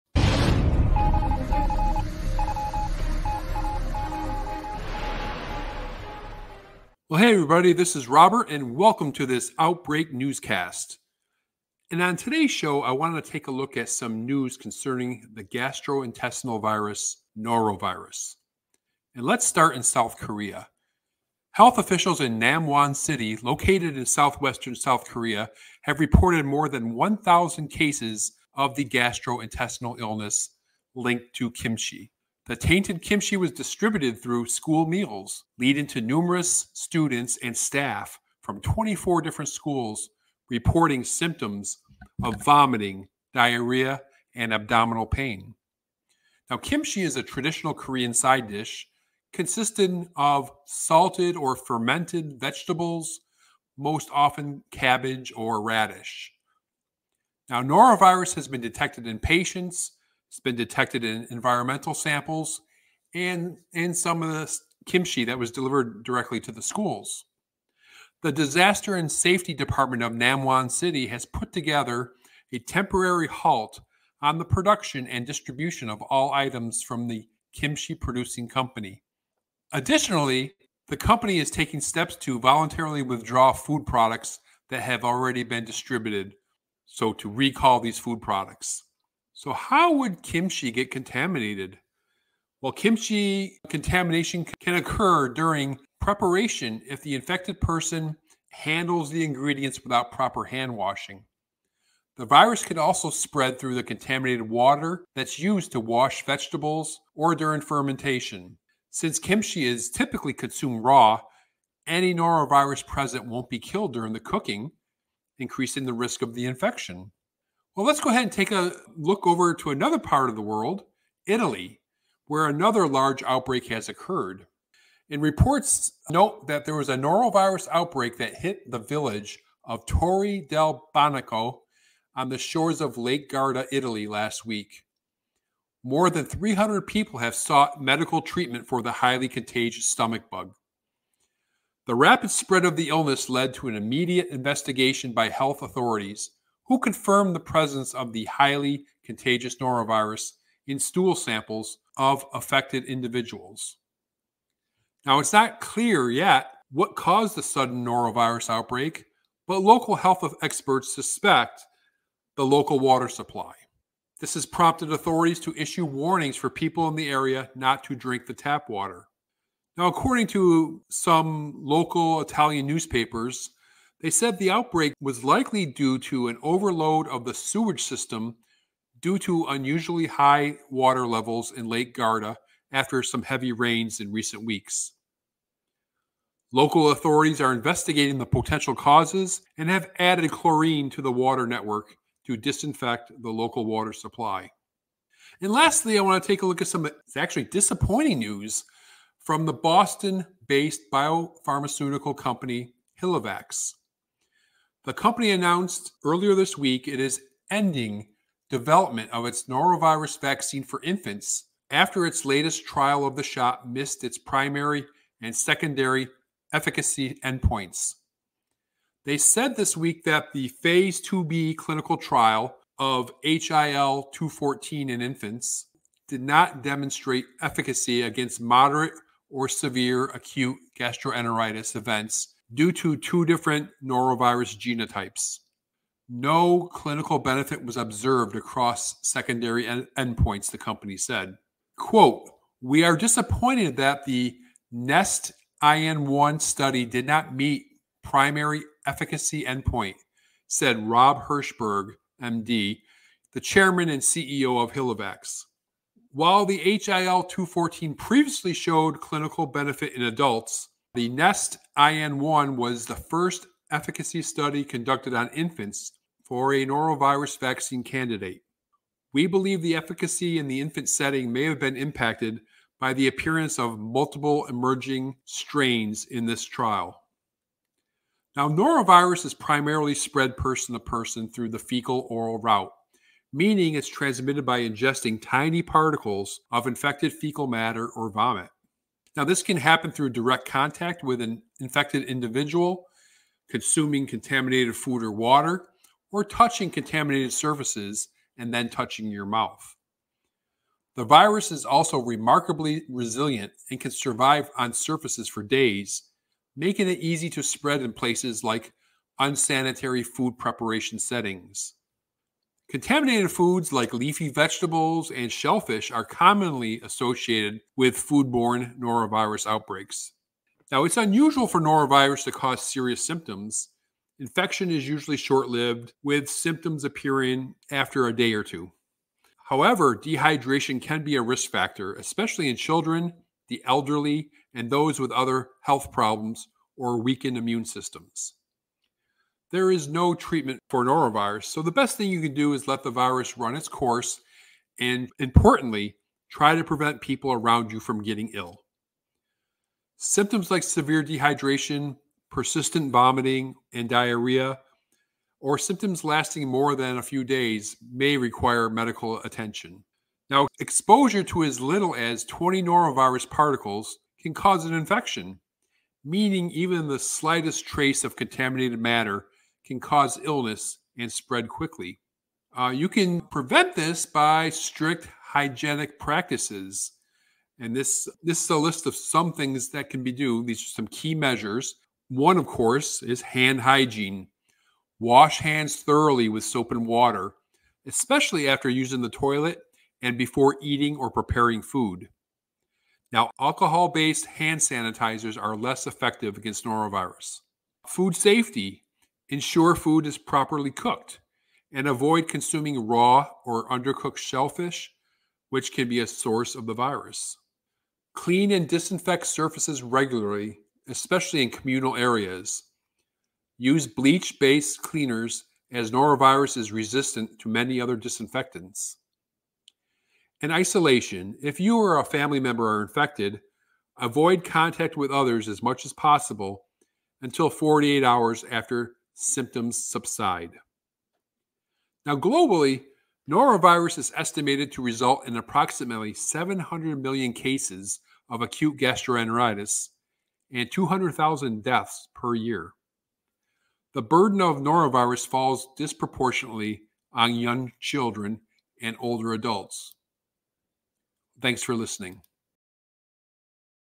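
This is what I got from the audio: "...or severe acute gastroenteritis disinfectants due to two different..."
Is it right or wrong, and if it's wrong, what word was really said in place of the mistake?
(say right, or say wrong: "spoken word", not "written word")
wrong: "events", not "disinfectants".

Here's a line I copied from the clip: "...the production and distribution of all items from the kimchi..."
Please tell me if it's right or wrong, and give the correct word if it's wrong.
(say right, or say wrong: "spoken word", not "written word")
right.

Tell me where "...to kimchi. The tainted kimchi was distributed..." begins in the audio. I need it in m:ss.
0:31.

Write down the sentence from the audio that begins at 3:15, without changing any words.
And lastly, I want to take a look at some it's actually disappointing news from the Boston based biopharmaceutical company HilleVax.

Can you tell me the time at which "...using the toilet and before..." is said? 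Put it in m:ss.
6:28.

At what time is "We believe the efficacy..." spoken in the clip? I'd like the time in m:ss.
4:29.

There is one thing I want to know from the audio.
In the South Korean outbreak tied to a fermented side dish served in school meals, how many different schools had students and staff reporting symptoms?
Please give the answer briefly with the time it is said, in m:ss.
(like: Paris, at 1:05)
24, at 0:38.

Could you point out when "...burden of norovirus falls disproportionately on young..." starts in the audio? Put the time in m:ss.
7:24.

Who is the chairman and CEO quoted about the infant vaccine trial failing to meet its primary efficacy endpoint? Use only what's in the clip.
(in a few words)
Rob Hershberg.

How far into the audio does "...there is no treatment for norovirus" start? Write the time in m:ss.
5:39.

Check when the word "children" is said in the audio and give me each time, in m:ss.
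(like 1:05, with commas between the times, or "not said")
5:32, 7:27.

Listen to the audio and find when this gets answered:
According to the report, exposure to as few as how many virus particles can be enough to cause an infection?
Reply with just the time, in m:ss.
6:02.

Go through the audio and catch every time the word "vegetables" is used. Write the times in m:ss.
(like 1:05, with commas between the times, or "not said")
0:52, 1:46, 5:14.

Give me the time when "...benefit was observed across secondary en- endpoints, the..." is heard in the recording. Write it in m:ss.
3:57.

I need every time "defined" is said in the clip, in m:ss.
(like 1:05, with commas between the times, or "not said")
not said.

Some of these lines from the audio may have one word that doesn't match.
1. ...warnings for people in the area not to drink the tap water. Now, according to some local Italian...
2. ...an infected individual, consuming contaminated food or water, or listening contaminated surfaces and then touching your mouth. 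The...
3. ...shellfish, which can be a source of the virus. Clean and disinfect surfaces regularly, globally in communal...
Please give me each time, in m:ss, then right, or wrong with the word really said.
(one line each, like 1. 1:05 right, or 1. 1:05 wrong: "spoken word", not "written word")
1. 2:45 right
2. 4:51 wrong: "touching", not "listening"
3. 6:44 wrong: "especially", not "globally".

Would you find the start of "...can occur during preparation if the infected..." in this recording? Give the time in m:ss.
1:34.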